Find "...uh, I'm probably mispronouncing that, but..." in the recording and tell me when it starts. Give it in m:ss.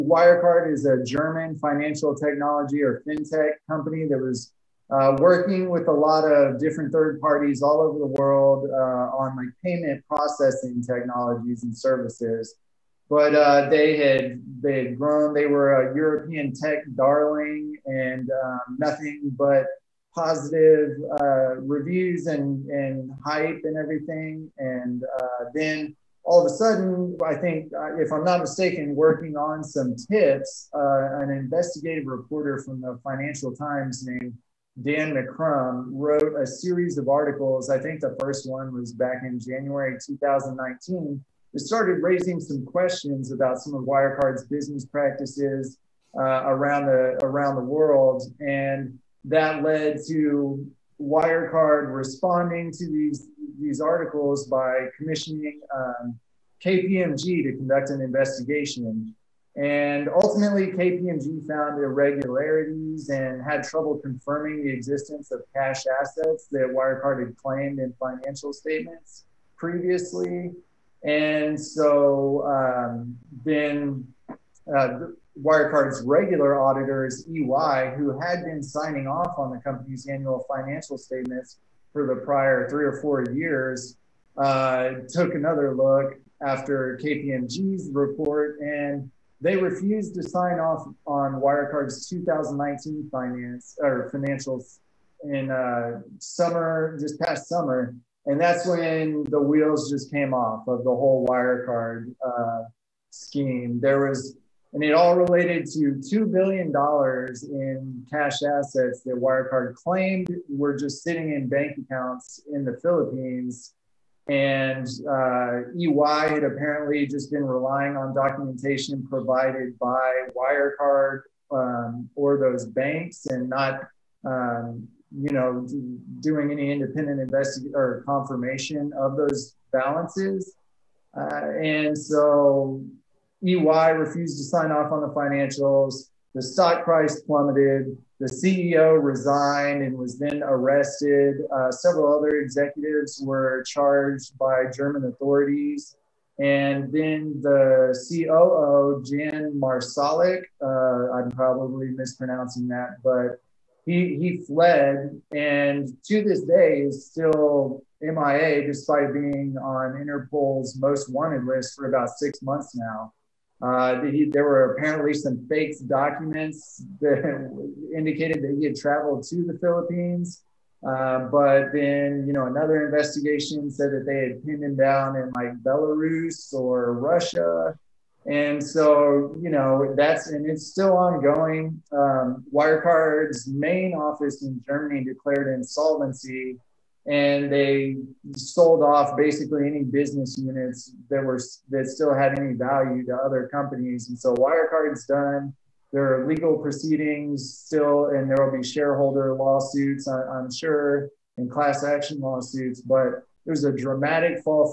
2:30.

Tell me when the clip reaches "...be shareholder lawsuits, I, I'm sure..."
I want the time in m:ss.
3:18.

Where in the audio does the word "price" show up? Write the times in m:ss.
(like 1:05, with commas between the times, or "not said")
2:16.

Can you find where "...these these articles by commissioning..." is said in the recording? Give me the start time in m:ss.
0:52.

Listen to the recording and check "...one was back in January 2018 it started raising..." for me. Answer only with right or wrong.
wrong.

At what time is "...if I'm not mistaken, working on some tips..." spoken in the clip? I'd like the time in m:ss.
0:27.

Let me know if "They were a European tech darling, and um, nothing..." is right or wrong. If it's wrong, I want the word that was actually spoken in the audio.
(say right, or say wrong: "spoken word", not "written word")
right.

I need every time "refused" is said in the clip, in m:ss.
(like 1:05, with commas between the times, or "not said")
1:29, 2:13.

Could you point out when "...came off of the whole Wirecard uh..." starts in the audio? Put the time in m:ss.
1:40.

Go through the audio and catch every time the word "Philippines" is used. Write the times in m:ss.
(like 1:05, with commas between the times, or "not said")
1:52, 2:49.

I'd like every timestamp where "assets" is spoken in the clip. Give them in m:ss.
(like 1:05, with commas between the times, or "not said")
1:05, 1:48.